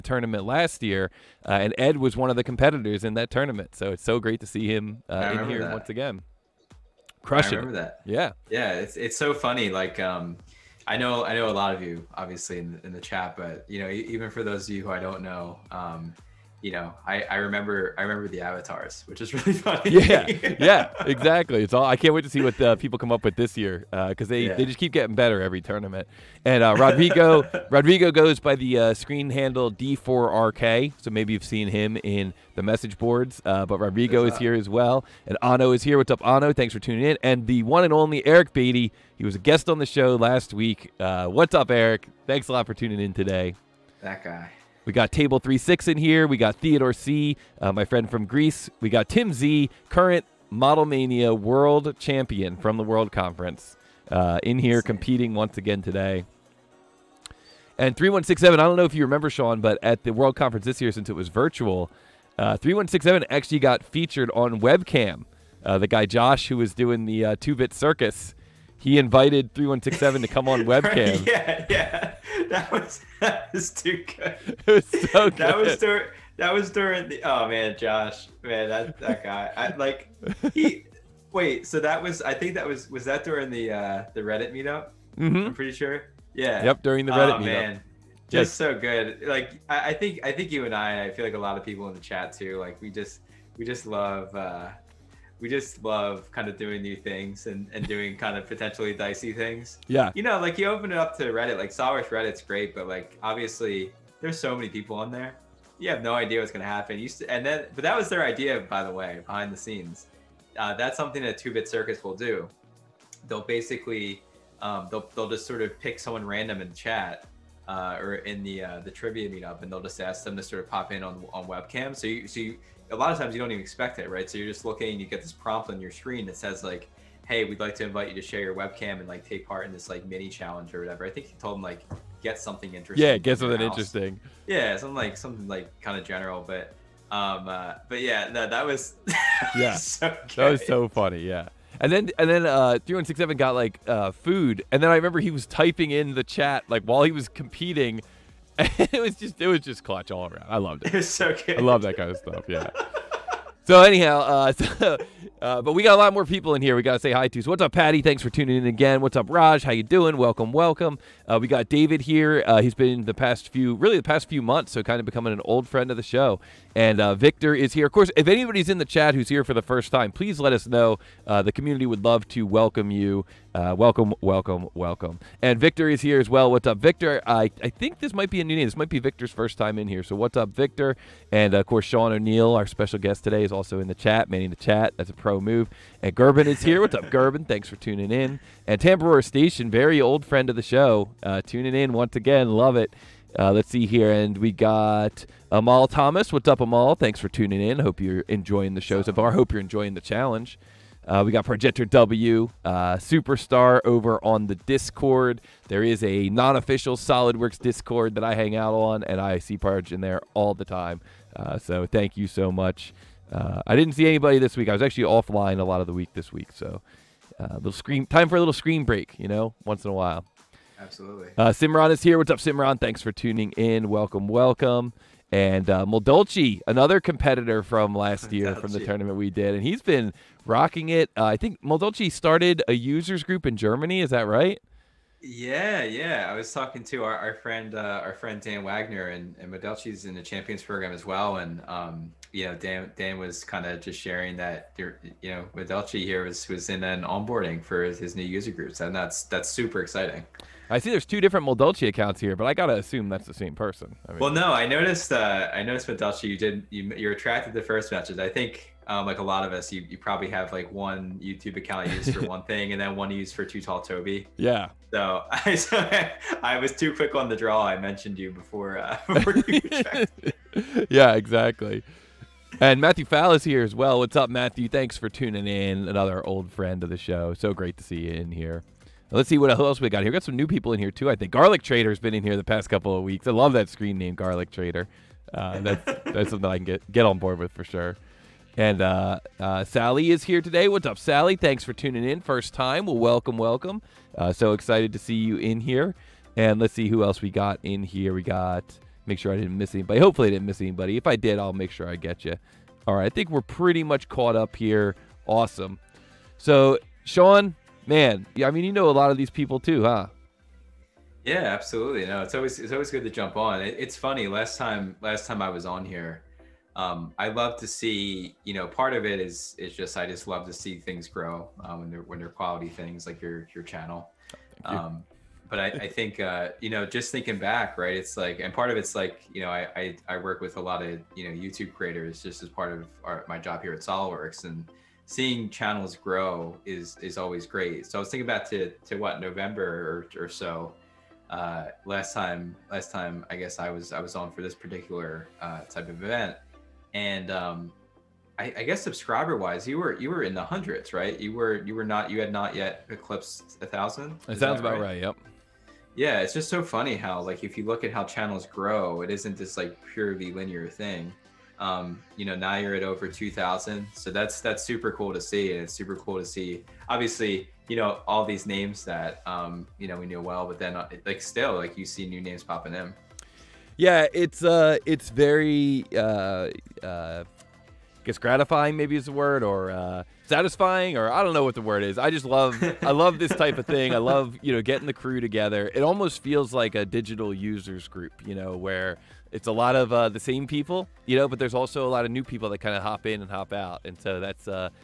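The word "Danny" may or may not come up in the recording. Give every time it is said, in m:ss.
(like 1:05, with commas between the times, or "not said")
not said.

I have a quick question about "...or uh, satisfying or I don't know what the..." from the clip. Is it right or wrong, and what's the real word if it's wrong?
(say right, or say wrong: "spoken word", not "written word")
right.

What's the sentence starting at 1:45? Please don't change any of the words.
You have no idea what's going to happen.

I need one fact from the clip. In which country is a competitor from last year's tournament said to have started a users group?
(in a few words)
Germany.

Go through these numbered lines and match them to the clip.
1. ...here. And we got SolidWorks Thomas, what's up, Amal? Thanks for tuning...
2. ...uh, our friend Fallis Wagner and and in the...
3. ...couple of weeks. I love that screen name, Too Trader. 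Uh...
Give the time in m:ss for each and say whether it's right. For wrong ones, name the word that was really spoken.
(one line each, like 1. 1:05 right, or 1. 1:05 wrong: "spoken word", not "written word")
1. 3:13 wrong: "Amal", not "SolidWorks"
2. 3:57 wrong: "Dan", not "Fallis"
3. 4:42 wrong: "Garlic", not "Too".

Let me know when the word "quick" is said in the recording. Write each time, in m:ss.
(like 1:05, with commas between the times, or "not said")
4:26.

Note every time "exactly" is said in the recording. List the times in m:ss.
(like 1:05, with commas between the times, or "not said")
0:21, 4:31.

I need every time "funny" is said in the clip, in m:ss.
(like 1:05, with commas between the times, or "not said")
0:09, 0:19, 2:20, 5:13, 5:56.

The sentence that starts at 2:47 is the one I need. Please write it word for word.
Of course, if anybody's in the chat who's here for the first time, please let us know.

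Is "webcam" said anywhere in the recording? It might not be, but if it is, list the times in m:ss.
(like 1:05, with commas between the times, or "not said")
1:04, 1:10, 2:01, 2:08.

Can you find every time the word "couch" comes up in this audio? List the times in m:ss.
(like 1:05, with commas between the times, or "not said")
not said.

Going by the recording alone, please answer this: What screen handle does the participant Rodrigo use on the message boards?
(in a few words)
D4RK.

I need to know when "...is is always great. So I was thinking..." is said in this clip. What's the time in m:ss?
5:36.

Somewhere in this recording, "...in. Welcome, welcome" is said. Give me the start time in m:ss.
3:43.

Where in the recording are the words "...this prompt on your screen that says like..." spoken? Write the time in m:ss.
2:05.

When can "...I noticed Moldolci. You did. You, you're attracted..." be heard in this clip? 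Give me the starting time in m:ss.
4:15.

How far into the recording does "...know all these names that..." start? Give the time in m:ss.
6:07.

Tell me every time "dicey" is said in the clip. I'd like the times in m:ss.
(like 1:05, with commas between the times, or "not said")
1:38.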